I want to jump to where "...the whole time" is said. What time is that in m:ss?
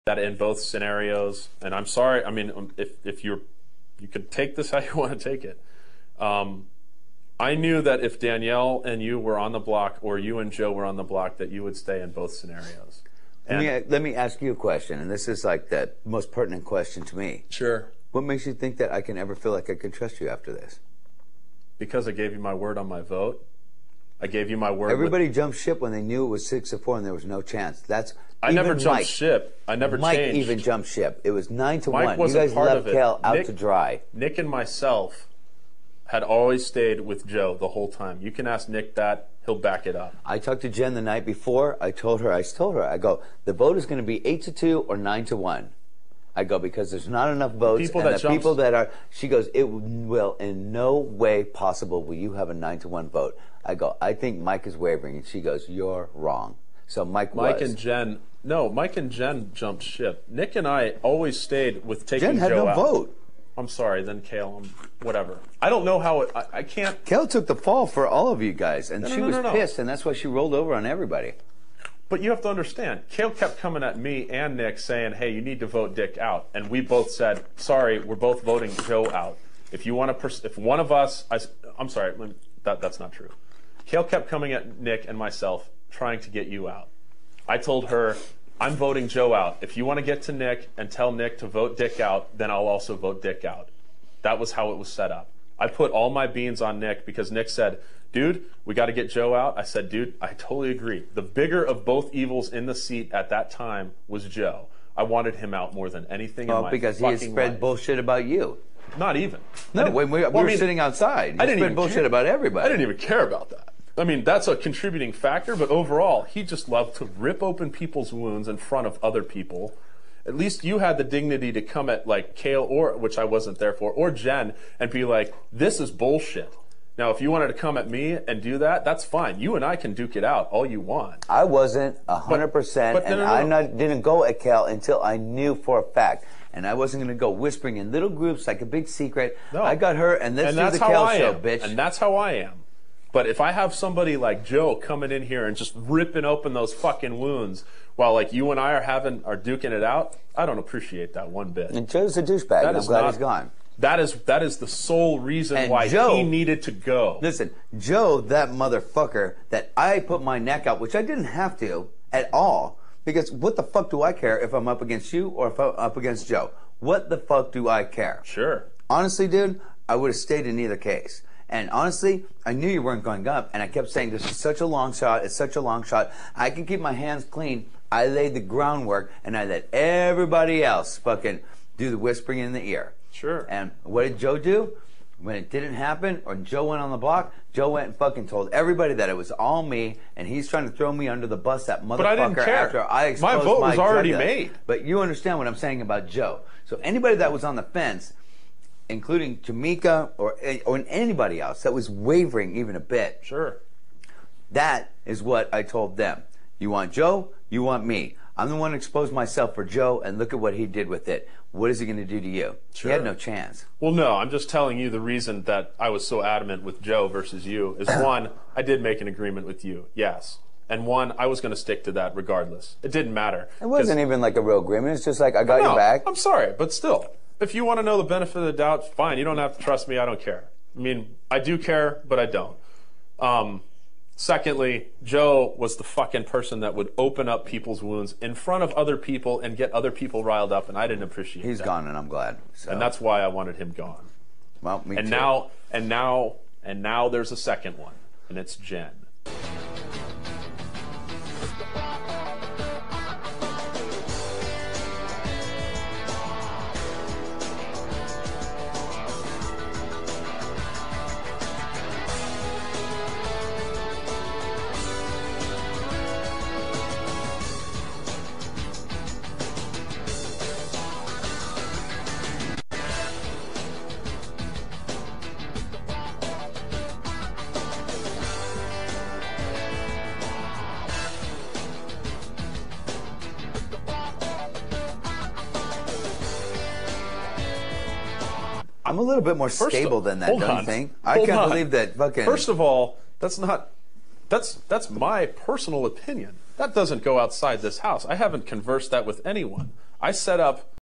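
0:37.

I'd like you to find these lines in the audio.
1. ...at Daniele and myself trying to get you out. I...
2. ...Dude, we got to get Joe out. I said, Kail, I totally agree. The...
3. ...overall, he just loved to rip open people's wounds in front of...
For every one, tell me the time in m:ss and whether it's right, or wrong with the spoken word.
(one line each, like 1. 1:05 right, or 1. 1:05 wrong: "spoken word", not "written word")
1. 1:24 wrong: "Nick", not "Daniele"
2. 1:38 wrong: "Dude", not "Kail"
3. 1:55 right.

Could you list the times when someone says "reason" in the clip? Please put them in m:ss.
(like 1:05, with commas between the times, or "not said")
2:35, 3:35.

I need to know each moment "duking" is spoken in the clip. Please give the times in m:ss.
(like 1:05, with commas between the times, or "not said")
2:29.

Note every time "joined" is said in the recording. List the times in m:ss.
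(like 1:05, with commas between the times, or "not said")
not said.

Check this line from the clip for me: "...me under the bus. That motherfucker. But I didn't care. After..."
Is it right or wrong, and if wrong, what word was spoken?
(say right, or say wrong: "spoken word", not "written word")
right.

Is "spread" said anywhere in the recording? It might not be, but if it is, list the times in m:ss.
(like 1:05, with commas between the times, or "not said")
1:47, 1:51.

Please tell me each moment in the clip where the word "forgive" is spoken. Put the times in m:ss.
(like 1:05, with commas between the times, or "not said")
not said.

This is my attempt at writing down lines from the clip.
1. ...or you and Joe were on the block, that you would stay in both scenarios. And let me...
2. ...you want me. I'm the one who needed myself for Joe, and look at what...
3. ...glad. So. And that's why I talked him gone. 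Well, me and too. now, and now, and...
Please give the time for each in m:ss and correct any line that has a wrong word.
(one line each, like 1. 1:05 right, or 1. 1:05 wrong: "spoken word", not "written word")
1. 0:10 right
2. 3:27 wrong: "exposed", not "needed"
3. 4:02 wrong: "wanted", not "talked".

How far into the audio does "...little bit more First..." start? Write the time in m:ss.
4:49.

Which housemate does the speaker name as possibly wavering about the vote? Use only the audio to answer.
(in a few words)
Jamaica.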